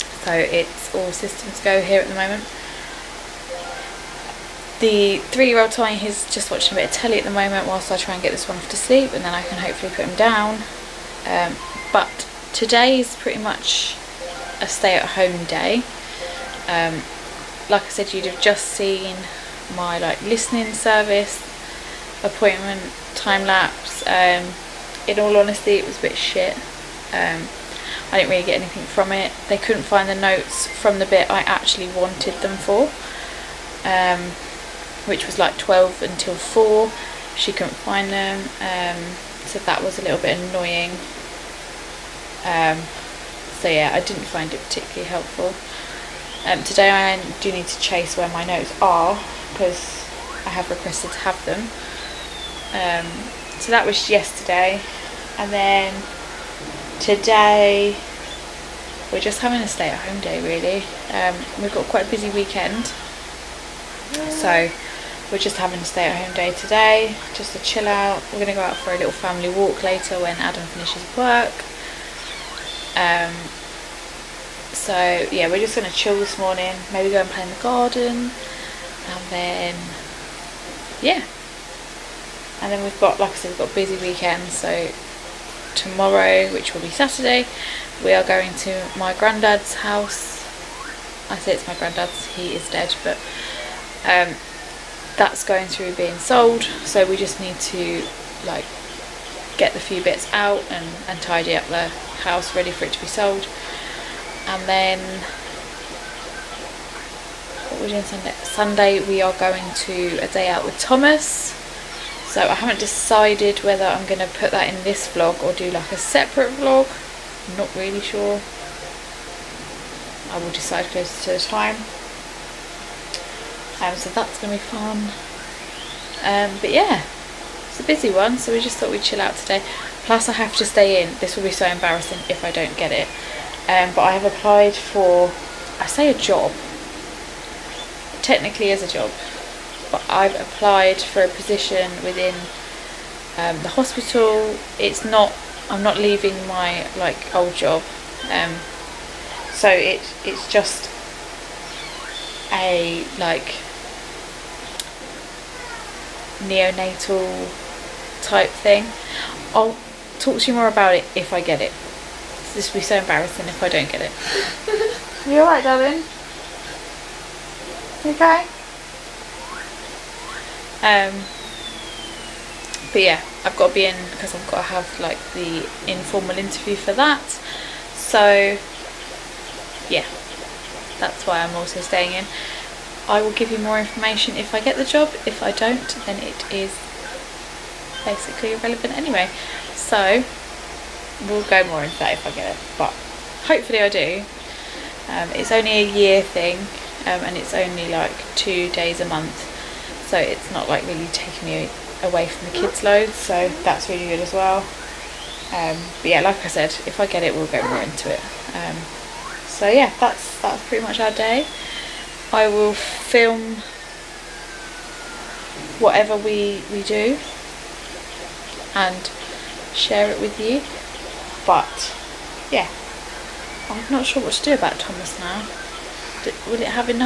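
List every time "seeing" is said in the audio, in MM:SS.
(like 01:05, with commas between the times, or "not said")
not said.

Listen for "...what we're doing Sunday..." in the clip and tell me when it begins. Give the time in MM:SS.
01:47.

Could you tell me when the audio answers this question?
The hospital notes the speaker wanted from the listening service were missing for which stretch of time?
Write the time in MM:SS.
00:35.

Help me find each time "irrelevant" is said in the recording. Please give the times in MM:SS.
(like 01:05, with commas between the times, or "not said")
03:08.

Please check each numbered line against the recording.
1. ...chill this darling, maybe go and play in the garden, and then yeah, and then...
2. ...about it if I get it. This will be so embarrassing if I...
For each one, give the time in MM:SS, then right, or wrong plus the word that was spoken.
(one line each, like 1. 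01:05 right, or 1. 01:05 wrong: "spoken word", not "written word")
1. 01:15 wrong: "morning", not "darling"
2. 02:40 right.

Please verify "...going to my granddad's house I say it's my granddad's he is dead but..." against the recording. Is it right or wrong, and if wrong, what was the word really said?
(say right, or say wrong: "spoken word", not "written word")
right.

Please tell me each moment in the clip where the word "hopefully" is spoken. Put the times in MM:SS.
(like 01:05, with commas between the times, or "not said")
00:09, 03:13.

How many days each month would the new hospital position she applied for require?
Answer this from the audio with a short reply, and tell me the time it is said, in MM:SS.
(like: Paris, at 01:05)
2 days, at 03:18.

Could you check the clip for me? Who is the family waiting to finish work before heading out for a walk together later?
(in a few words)
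Adam.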